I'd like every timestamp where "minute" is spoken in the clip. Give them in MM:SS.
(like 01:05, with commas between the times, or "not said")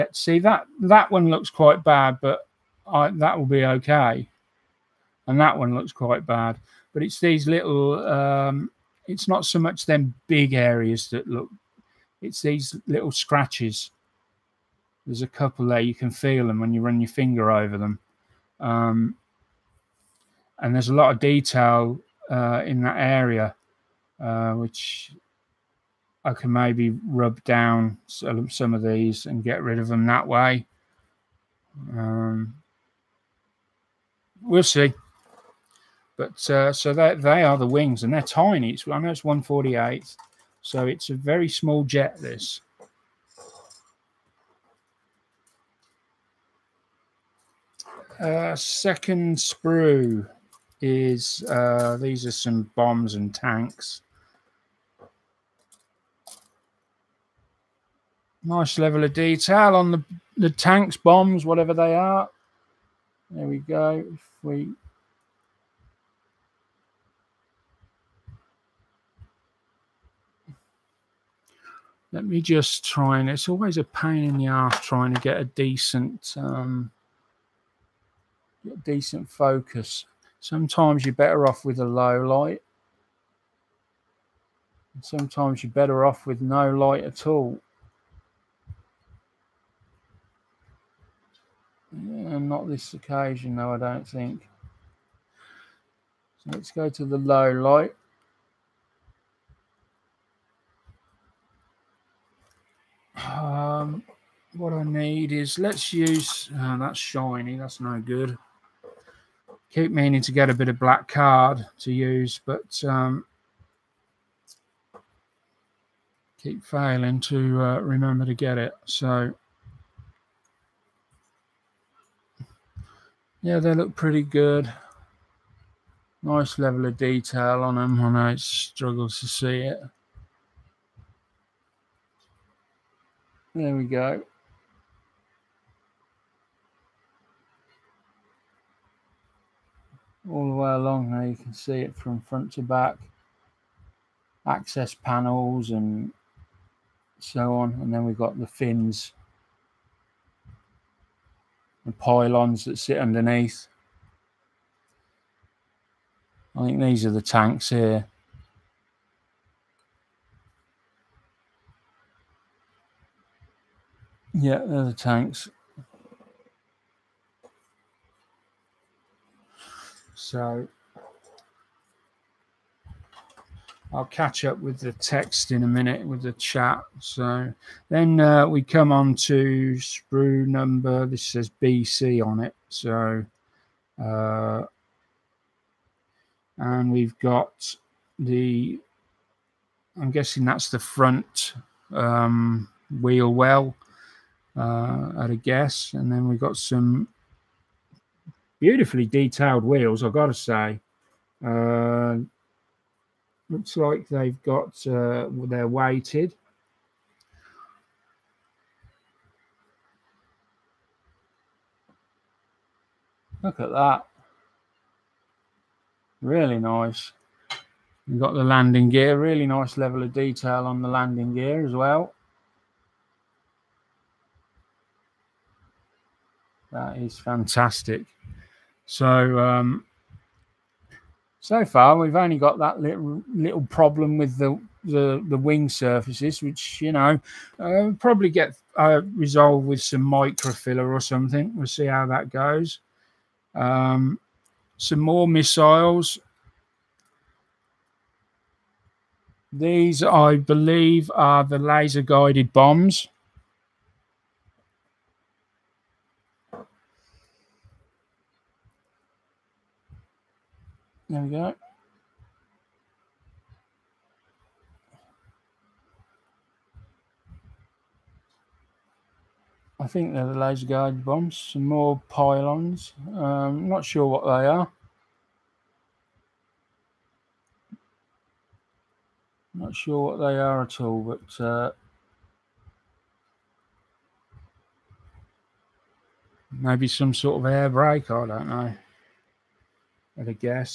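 02:55.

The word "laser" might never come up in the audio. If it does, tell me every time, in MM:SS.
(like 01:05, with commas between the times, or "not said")
04:11, 04:30.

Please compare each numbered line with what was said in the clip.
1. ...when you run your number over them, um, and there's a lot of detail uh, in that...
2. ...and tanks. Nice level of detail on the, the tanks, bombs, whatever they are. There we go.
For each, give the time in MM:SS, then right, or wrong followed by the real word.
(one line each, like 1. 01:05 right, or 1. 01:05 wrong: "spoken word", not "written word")
1. 00:16 wrong: "finger", not "number"
2. 00:53 right.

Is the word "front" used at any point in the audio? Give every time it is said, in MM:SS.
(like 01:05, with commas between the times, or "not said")
02:22, 03:10.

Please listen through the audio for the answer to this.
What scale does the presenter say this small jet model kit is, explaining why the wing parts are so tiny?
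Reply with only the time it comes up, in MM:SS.
00:39.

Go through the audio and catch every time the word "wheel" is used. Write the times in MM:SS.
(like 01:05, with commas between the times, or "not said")
03:13, 03:19.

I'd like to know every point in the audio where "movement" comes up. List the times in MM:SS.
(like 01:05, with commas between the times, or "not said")
not said.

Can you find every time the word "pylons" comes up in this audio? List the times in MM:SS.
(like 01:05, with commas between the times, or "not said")
02:31, 04:32.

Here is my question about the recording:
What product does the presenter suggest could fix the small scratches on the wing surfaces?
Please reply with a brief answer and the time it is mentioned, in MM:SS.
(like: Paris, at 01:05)
Microfiller, at 04:00.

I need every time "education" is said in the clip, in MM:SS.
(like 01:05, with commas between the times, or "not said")
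not said.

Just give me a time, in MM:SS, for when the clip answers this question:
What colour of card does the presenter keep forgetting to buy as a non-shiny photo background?
01:50.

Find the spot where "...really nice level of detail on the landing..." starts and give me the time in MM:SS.
03:39.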